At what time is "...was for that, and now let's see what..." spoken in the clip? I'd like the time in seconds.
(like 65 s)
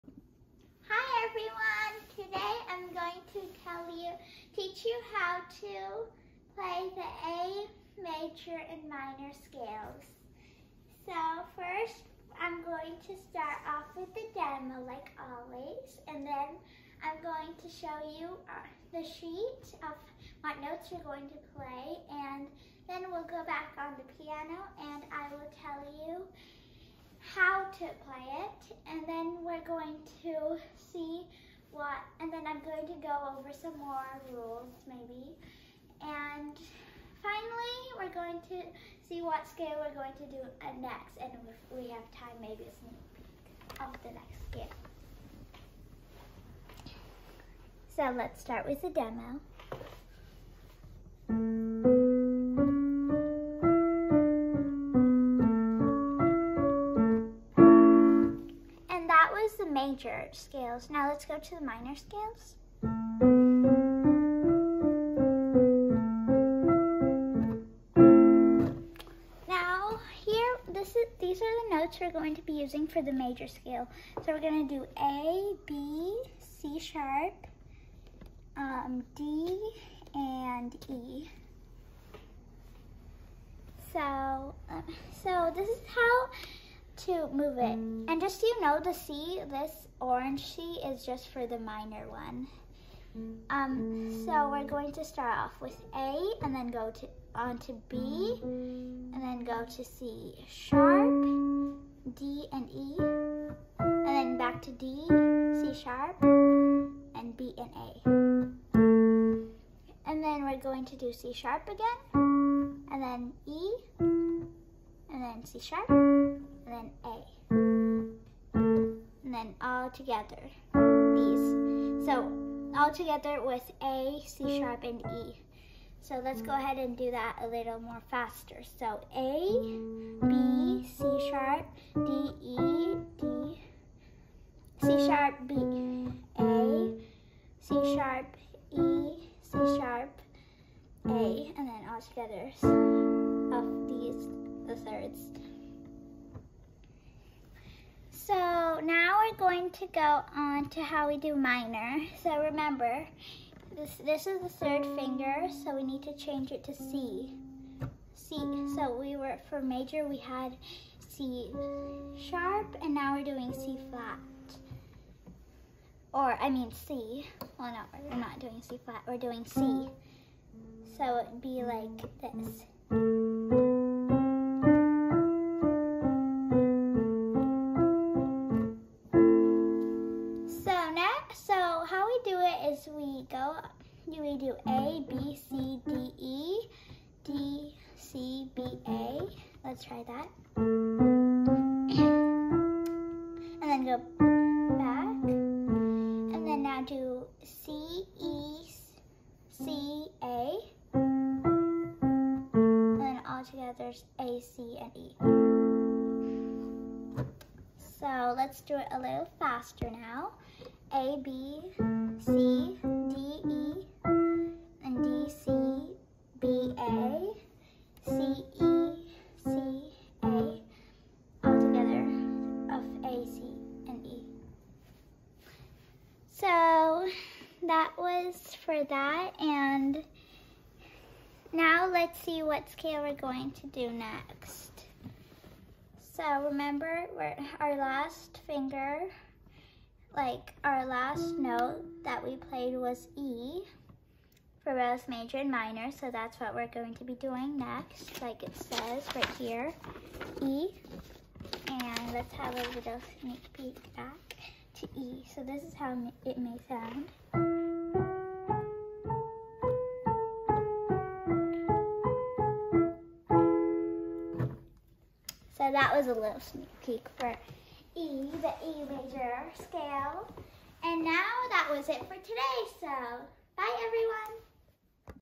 227 s.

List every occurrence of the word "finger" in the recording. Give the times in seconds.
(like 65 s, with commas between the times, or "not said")
154 s, 238 s.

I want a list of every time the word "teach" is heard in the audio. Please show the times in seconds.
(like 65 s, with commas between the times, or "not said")
4 s.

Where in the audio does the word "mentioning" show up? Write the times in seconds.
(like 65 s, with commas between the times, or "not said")
not said.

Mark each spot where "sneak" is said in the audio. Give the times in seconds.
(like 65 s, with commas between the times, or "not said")
42 s, 253 s, 266 s.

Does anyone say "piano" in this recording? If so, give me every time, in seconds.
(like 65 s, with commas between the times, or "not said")
24 s.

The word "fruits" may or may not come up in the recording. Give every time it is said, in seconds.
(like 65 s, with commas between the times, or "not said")
not said.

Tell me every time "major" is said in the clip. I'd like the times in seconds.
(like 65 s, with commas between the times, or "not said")
8 s, 60 s, 73 s, 159 s, 245 s, 268 s.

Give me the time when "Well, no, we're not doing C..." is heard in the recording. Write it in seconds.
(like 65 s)
167 s.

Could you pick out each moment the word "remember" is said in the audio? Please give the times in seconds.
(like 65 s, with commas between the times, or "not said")
152 s, 236 s.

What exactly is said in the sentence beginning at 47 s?
So let's start with the demo.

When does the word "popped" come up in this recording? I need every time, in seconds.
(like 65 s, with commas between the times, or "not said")
not said.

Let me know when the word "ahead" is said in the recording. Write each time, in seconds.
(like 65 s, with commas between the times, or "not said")
126 s.